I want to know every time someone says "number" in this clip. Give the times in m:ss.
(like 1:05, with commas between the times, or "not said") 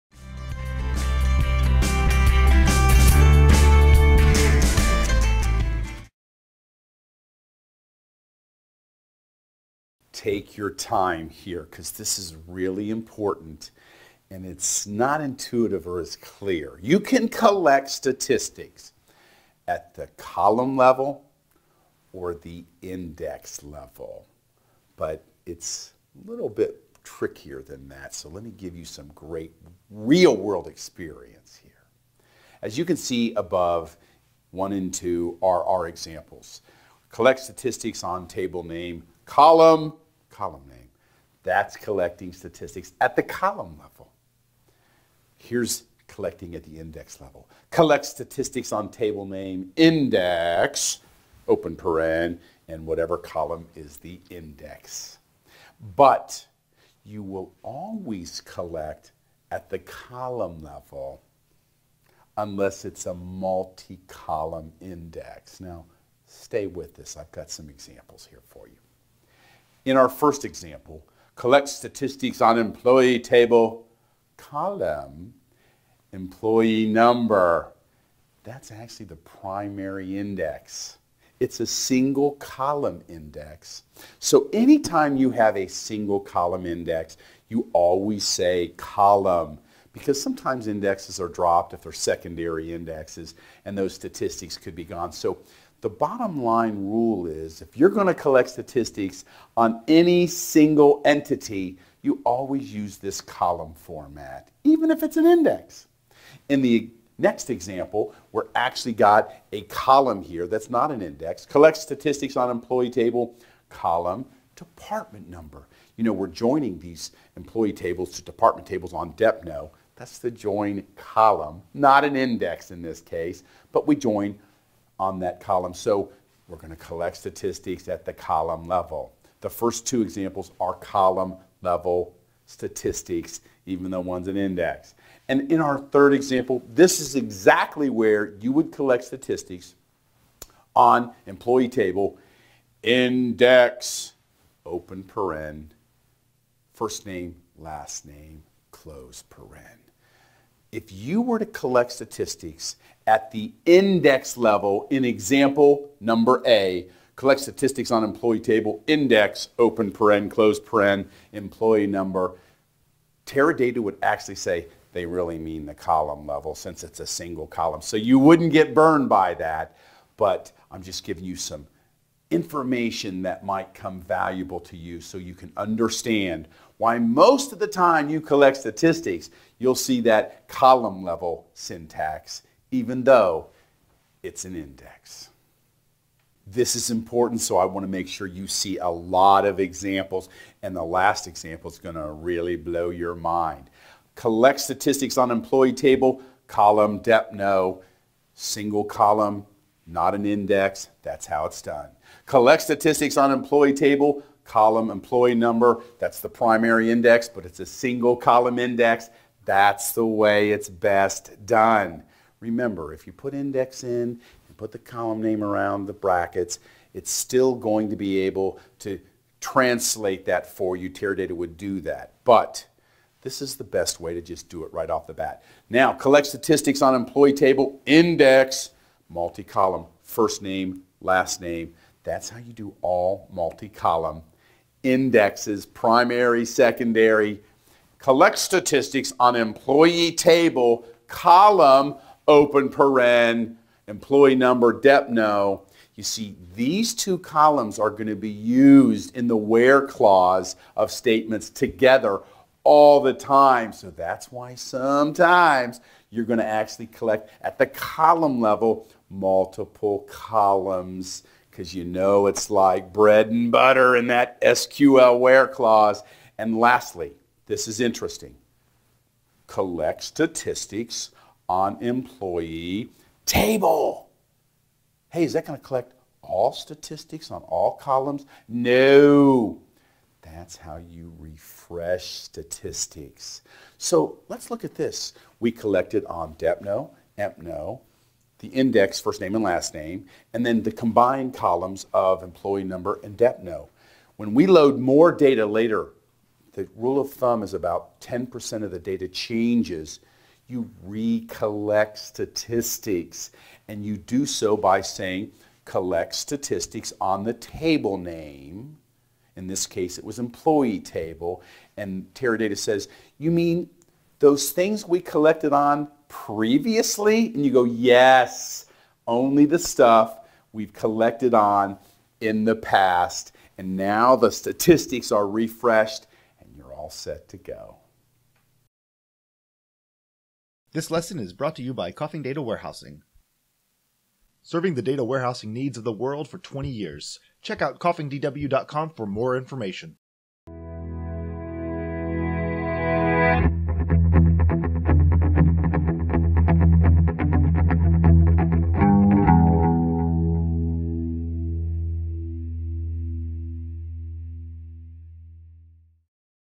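1:16, 1:55, 2:35, 2:41, 3:25, 4:04, 4:52.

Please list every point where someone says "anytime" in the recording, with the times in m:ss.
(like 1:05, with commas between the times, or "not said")
1:24.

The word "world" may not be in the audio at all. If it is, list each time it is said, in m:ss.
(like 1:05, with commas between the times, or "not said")
0:30, 5:35.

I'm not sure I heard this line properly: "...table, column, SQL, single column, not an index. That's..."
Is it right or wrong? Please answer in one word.
wrong.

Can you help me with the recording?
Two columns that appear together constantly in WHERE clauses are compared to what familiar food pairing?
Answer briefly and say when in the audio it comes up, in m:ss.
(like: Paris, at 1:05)
bread and butter, at 4:22.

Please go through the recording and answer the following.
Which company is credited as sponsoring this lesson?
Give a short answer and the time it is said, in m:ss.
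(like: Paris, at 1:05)
Coffing Data Warehousing, at 5:31.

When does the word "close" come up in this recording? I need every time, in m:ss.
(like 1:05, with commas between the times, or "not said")
2:28, 2:40.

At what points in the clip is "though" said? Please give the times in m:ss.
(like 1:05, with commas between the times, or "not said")
2:13, 3:03.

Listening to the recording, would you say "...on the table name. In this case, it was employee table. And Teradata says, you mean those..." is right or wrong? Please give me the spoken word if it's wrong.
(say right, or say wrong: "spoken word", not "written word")
right.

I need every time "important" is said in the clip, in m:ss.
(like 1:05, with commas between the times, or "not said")
0:12, 3:06.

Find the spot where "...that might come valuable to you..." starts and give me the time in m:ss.
2:53.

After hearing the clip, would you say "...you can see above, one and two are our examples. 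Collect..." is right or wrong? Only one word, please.
right.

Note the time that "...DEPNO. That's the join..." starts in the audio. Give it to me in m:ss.
1:59.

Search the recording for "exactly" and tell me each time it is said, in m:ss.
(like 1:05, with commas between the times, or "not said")
2:17.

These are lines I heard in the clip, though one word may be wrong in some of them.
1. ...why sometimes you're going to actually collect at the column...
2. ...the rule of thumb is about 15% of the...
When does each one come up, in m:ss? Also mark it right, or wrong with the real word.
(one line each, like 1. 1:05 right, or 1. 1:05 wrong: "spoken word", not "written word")
1. 4:14 right
2. 4:56 wrong: "10", not "15".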